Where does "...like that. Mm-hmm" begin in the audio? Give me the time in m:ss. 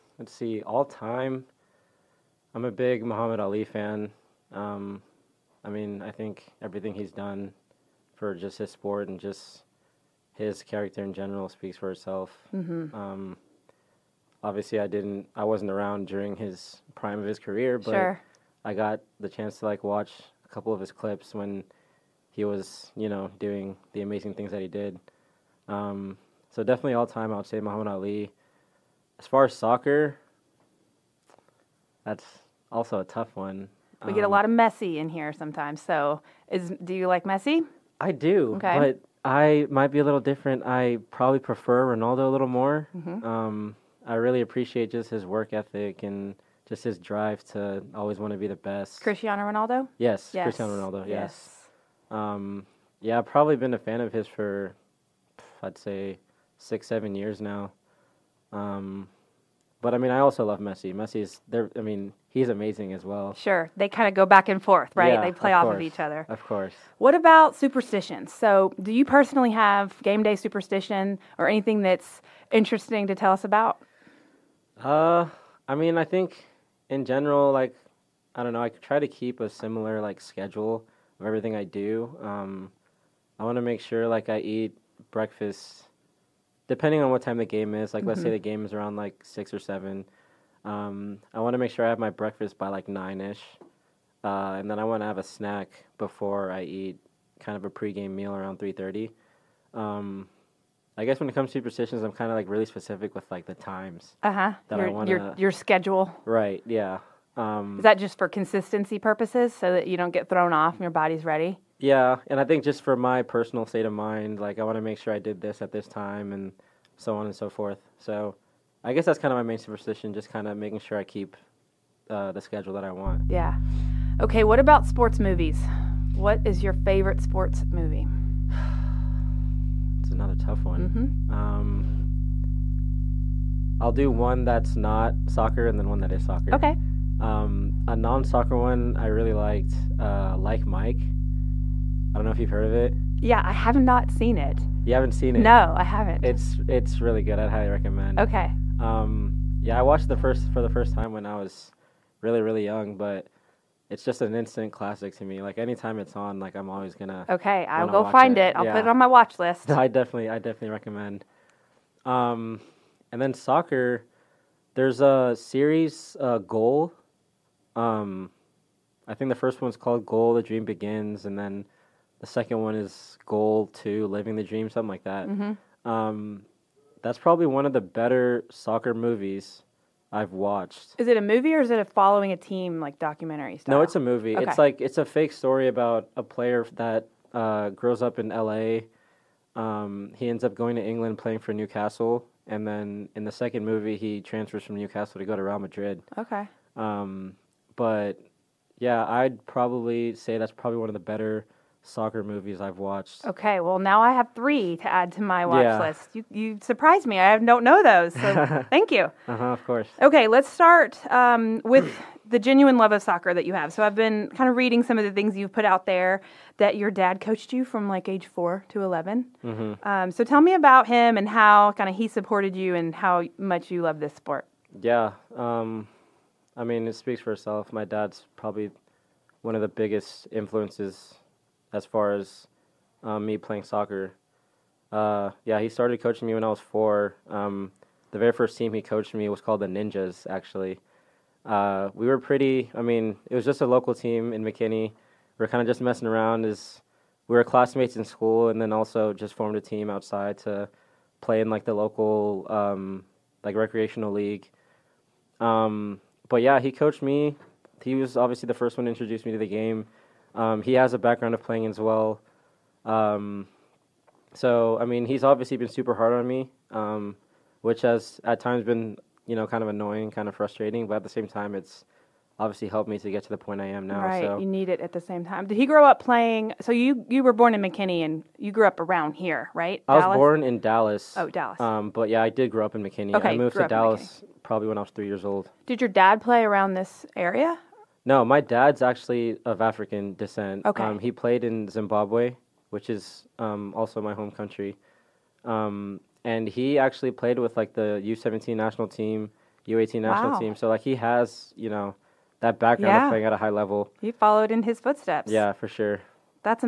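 2:54.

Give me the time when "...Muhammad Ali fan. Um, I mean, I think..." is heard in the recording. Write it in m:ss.
0:03.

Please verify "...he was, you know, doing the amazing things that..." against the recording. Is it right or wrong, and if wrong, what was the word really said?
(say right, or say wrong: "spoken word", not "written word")
right.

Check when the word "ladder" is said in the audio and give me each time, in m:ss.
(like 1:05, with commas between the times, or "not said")
not said.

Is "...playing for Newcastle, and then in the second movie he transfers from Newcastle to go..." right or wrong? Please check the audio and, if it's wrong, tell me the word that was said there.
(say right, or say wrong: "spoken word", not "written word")
right.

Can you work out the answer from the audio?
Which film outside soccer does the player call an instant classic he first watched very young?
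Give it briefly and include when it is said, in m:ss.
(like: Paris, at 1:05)
Like Mike, at 2:20.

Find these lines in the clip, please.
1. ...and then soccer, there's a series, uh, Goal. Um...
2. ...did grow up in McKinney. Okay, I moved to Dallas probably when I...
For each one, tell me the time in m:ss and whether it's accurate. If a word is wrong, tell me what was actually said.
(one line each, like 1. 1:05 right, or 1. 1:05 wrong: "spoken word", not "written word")
1. 2:43 right
2. 4:42 right.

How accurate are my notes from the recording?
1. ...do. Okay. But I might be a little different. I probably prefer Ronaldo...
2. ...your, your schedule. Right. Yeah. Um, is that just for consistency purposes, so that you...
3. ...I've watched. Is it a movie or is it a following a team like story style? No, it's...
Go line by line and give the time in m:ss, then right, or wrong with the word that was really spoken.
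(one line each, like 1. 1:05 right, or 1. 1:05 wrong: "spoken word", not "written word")
1. 0:38 right
2. 1:45 right
3. 3:00 wrong: "documentary", not "story".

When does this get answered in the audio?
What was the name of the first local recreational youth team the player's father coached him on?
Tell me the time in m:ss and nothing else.
3:59.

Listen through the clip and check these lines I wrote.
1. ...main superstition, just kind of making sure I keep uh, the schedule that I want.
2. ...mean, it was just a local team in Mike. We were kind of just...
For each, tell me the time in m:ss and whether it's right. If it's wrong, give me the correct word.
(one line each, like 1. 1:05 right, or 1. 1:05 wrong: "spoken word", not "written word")
1. 1:59 right
2. 4:02 wrong: "McKinney", not "Mike".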